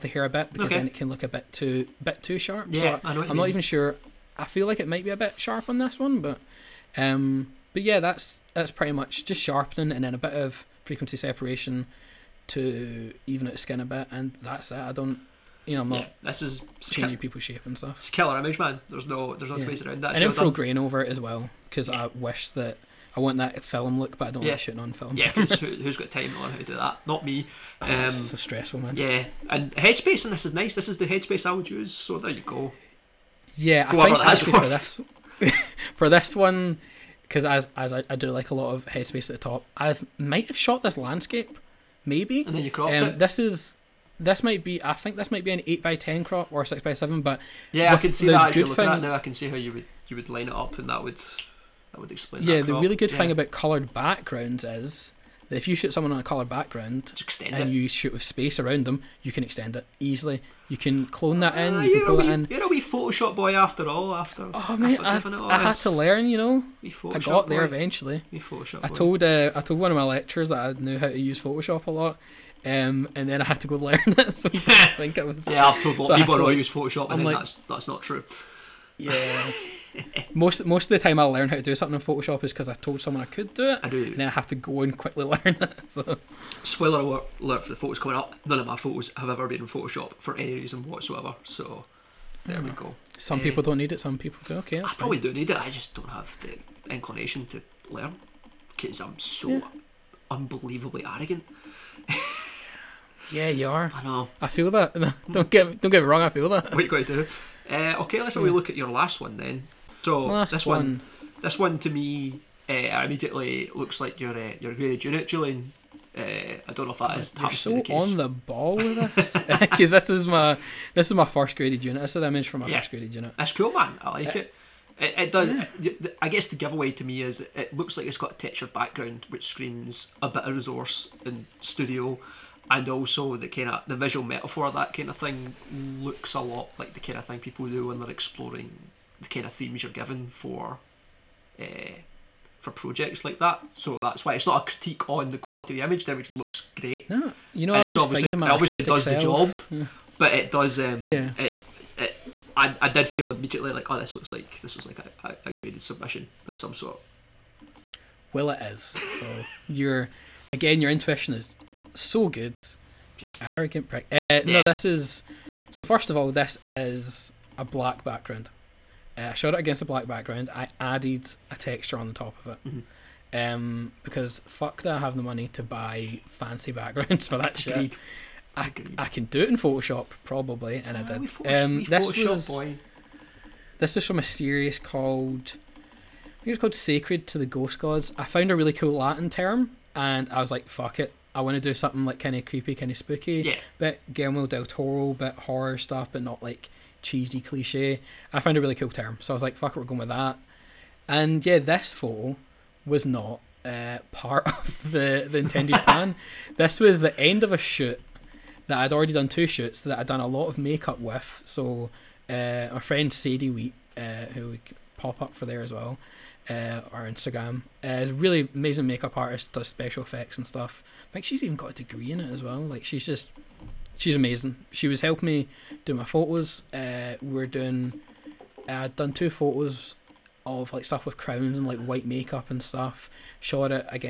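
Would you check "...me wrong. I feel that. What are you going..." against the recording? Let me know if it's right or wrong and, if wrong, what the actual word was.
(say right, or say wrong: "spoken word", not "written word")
right.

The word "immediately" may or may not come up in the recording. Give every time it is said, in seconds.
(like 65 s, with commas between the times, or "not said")
113 s, 153 s.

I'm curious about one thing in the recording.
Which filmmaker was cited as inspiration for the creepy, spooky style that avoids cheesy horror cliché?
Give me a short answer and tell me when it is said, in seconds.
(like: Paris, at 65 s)
Guillermo del Toro, at 194 s.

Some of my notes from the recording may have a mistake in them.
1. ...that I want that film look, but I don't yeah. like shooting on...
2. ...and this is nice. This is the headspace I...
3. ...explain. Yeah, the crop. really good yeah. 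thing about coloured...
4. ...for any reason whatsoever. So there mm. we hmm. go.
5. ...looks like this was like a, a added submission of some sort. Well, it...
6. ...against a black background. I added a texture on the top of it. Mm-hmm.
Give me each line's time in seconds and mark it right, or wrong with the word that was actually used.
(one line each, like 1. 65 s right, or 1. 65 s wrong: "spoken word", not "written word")
1. 22 s right
2. 30 s right
3. 52 s right
4. 90 s right
5. 154 s wrong: "graded", not "added"
6. 169 s right.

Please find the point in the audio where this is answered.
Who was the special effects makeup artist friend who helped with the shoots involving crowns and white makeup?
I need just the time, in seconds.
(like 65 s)
213 s.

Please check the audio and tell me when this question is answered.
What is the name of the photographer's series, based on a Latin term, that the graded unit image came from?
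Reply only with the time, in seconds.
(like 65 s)
186 s.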